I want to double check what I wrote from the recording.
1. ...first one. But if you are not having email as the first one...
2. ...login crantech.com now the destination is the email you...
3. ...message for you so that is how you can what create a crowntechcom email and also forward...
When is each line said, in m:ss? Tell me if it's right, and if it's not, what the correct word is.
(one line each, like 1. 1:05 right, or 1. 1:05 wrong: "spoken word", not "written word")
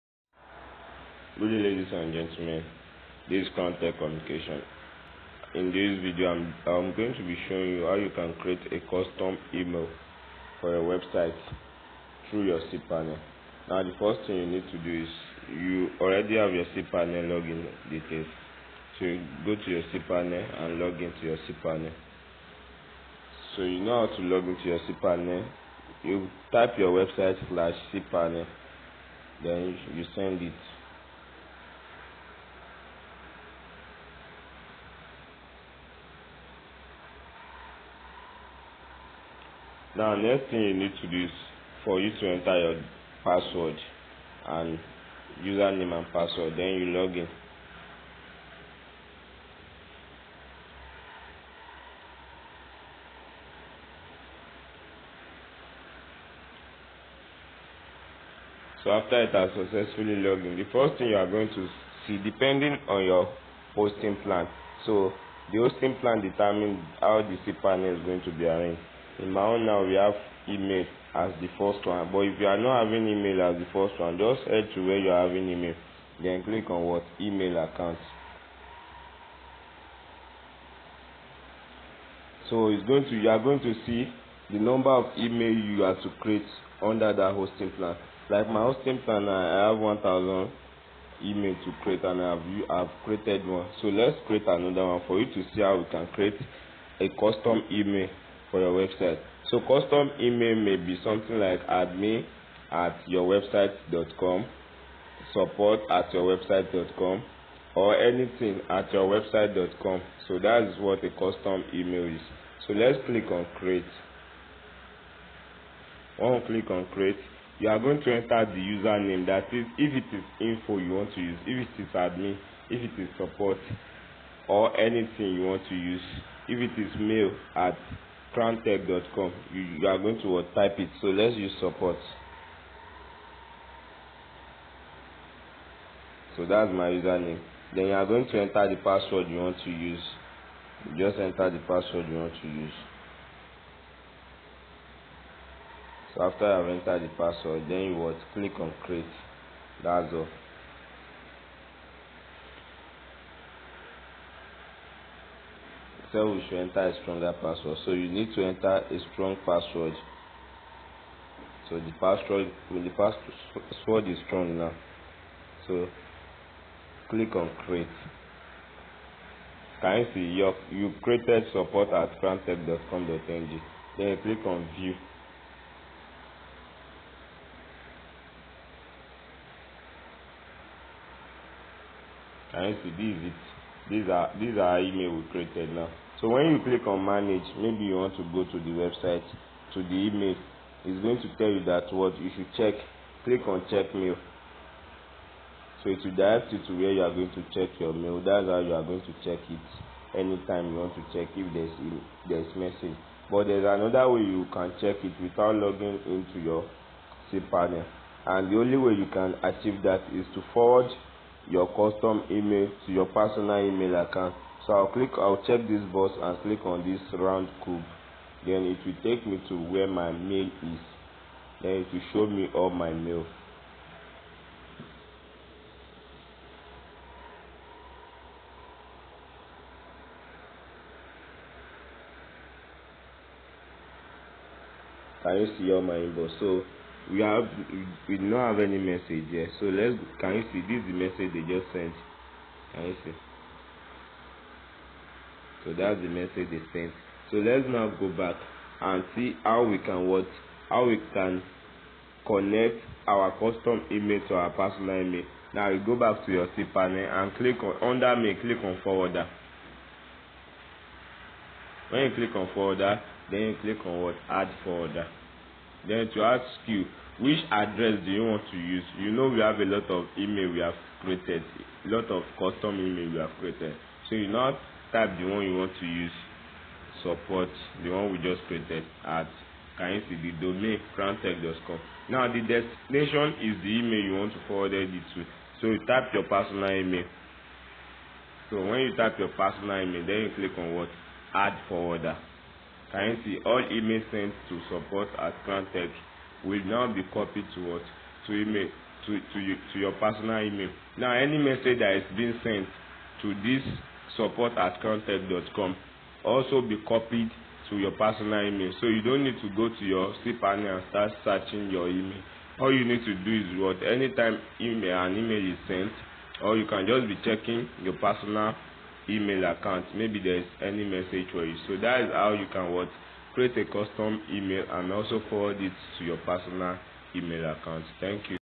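1. 1:11 right
2. 4:40 wrong: "domain", not "login"
3. 5:20 wrong: "custom", not "crowntechcom".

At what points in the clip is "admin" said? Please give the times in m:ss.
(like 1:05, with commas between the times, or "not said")
1:41, 2:01.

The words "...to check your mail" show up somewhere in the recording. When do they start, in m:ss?
3:17.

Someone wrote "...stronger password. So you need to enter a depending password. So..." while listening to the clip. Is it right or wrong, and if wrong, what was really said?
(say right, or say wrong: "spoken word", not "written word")
wrong: "strong", not "depending".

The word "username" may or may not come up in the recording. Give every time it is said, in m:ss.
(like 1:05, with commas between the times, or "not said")
0:45, 1:58, 2:16.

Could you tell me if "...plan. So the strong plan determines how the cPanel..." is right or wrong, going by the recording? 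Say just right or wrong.
wrong.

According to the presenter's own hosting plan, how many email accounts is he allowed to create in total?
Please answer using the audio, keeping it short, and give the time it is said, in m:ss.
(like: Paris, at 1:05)
1000, at 1:29.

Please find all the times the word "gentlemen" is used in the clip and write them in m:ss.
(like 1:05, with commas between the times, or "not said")
0:02.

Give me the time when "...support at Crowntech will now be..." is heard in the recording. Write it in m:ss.
4:54.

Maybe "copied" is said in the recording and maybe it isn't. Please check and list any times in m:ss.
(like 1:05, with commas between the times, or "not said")
4:57, 5:06.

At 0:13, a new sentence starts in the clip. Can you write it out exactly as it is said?
Now, the first thing you need to do is you already have your cPanel login details.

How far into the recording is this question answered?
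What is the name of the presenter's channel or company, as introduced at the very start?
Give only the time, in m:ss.
0:03.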